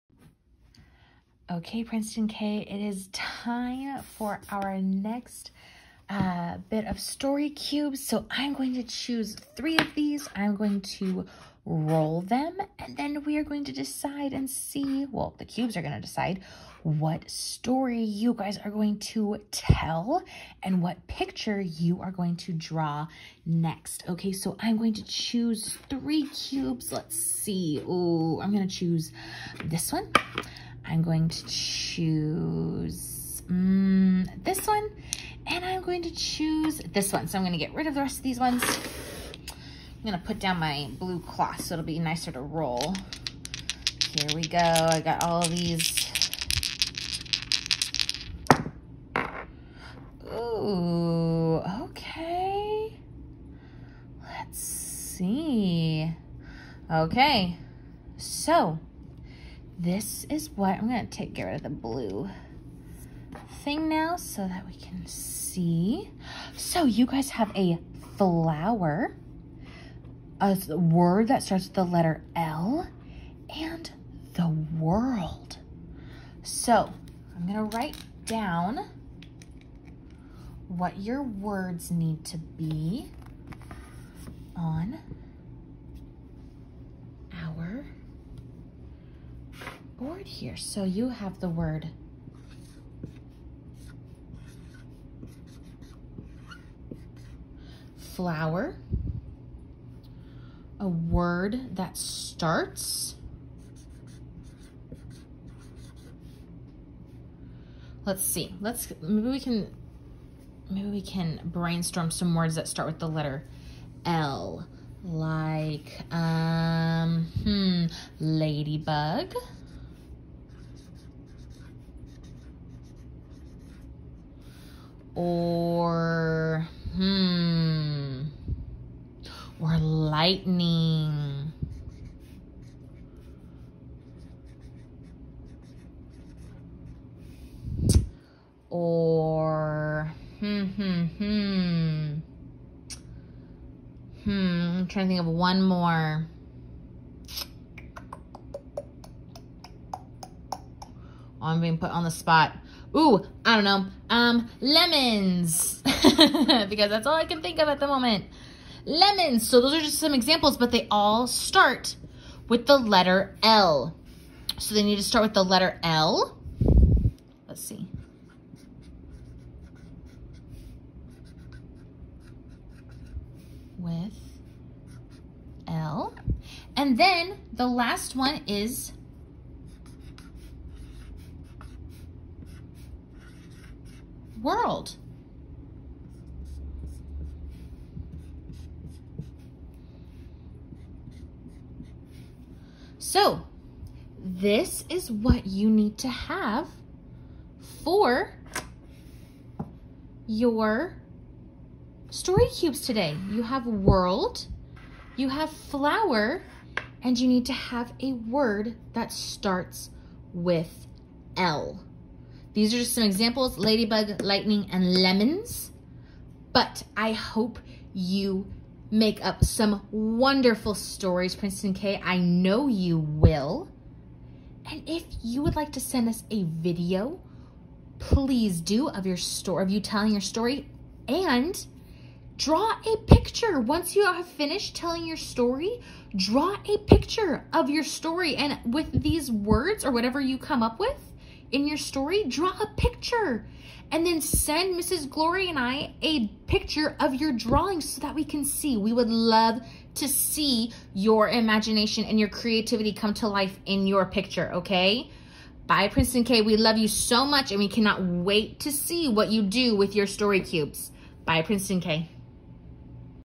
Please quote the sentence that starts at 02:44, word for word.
So they need to start with the letter L.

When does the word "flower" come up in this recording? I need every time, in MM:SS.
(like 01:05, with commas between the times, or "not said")
01:08, 01:37, 03:25.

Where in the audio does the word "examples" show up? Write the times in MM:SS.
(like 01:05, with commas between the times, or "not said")
02:40, 03:33.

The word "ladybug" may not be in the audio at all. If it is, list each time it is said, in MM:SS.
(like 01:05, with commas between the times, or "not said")
01:58, 03:33.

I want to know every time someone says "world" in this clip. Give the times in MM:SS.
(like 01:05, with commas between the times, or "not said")
01:14, 03:04, 03:23.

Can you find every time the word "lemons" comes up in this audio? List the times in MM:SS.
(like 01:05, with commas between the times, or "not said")
02:34, 02:38, 03:34.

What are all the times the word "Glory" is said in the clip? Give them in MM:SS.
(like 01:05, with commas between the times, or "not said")
04:05.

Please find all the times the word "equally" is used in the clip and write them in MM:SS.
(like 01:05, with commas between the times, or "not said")
not said.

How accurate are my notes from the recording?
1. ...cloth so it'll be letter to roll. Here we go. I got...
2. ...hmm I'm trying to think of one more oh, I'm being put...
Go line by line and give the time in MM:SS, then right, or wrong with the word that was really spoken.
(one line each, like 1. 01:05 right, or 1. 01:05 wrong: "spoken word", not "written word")
1. 00:41 wrong: "nicer", not "letter"
2. 02:24 right.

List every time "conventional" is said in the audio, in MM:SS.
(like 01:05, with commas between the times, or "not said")
not said.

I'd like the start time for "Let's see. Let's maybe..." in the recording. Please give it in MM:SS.
01:48.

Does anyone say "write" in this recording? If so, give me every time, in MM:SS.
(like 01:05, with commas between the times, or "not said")
01:17.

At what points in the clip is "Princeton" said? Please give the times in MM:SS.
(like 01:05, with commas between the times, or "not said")
00:01, 03:41, 04:15, 04:21.